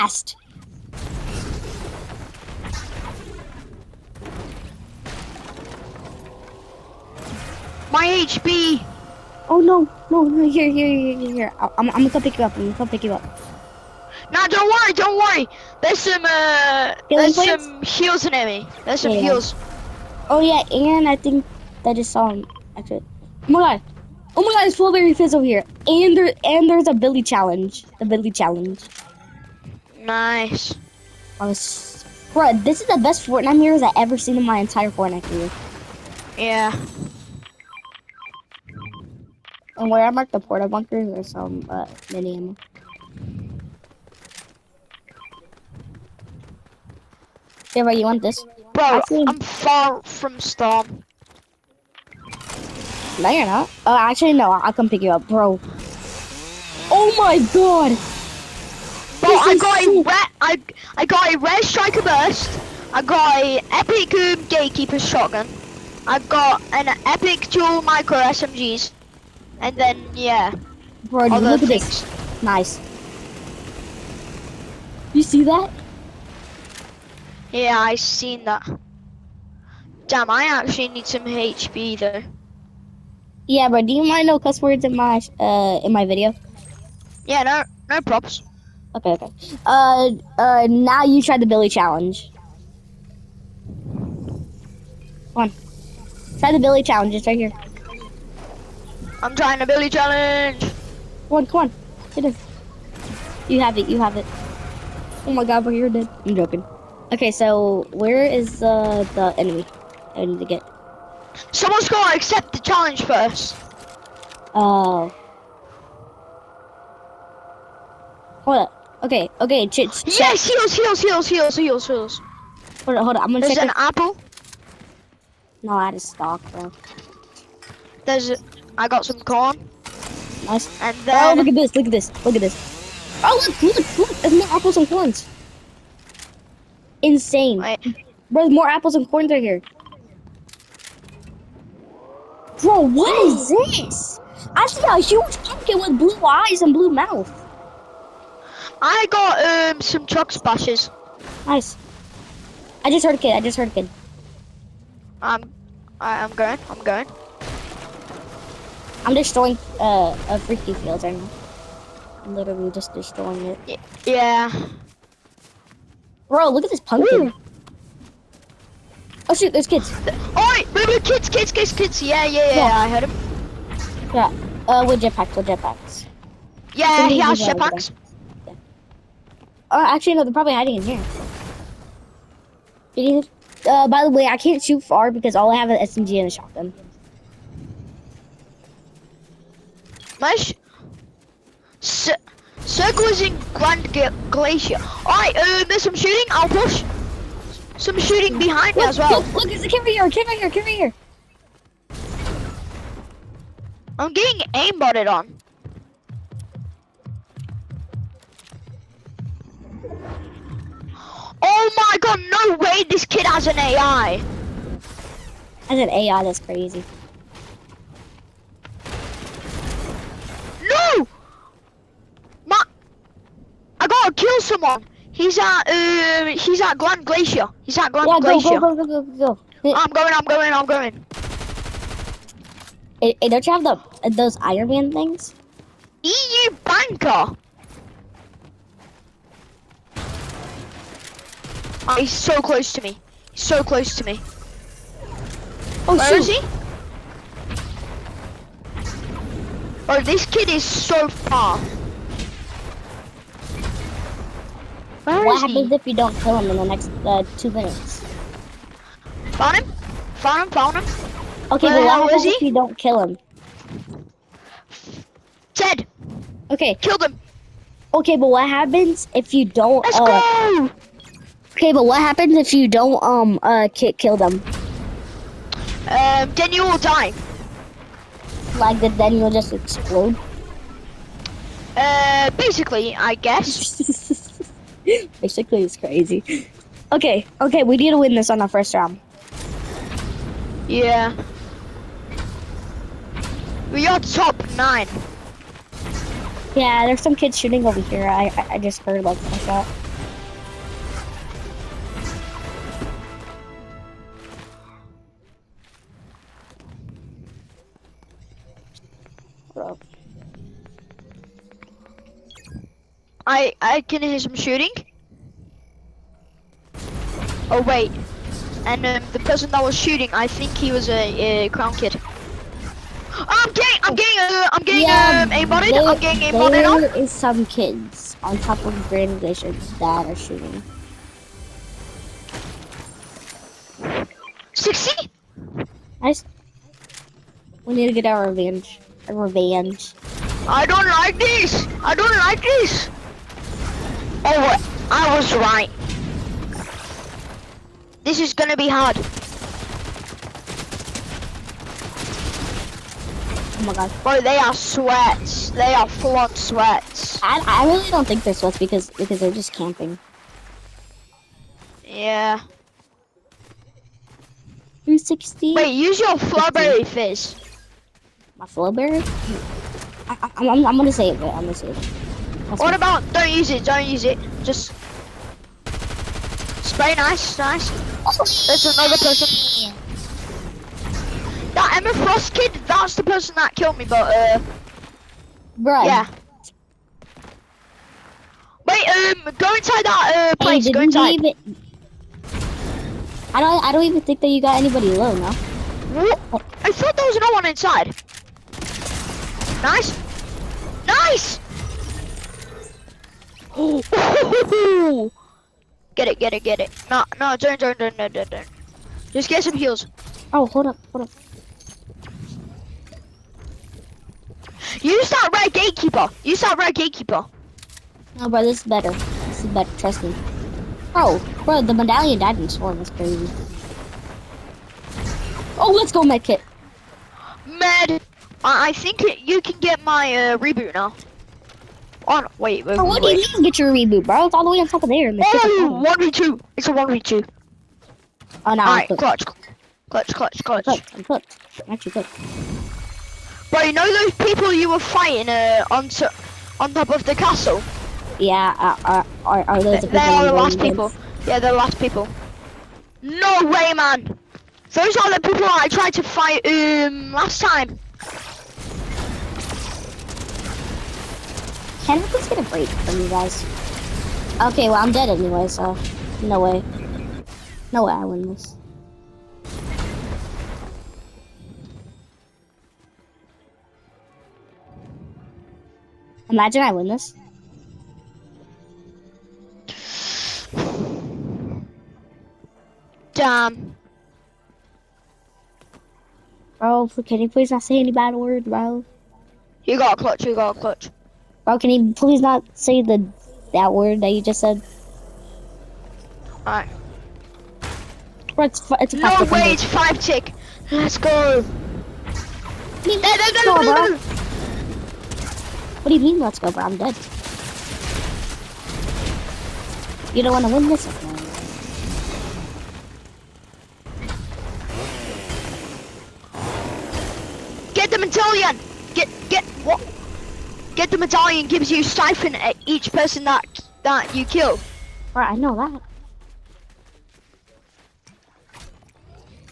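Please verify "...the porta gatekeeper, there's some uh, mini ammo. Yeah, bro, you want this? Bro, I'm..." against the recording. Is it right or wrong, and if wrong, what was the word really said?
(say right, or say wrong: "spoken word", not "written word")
wrong: "bunker", not "gatekeeper".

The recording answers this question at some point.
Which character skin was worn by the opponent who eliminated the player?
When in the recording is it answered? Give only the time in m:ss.
6:21.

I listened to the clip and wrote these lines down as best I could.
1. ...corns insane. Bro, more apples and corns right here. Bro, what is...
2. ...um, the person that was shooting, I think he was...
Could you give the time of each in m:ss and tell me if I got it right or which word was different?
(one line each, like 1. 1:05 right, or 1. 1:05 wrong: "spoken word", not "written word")
1. 2:14 right
2. 5:18 right.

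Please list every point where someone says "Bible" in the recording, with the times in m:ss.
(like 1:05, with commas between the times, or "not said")
not said.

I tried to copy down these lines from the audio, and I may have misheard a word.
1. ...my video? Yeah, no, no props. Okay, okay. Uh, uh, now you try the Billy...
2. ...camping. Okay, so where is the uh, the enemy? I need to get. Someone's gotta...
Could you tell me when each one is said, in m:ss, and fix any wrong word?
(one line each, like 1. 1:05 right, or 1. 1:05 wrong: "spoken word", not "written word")
1. 1:25 right
2. 1:46 wrong: "joking", not "camping".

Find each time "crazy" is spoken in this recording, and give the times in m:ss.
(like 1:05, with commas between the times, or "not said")
3:36, 4:45, 7:02.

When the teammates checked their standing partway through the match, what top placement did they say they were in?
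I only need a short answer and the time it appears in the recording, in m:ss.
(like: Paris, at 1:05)
9, at 4:53.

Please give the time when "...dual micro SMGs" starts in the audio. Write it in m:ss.
1:07.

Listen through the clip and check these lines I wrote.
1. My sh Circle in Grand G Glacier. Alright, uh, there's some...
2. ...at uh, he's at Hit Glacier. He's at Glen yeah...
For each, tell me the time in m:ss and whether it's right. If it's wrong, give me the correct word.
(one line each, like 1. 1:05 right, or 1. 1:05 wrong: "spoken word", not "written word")
1. 3:10 right
2. 3:45 wrong: "Grand", not "Hit".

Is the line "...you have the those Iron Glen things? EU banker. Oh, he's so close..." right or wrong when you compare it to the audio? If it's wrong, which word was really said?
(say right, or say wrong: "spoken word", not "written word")
wrong: "Man", not "Glen".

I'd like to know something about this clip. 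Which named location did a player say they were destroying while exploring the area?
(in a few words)
Freaky field.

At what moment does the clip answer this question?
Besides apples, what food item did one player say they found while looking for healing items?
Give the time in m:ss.
2:09.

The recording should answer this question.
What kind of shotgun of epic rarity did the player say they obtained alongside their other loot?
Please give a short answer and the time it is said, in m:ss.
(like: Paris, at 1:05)
Gatekeeper shotgun, at 1:04.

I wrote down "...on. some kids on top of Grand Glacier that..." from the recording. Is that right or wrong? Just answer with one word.
right.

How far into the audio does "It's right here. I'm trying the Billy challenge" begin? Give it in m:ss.
1:37.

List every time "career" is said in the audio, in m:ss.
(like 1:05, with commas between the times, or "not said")
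0:35.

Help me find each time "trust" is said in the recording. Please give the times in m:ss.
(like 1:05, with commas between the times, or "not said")
6:59.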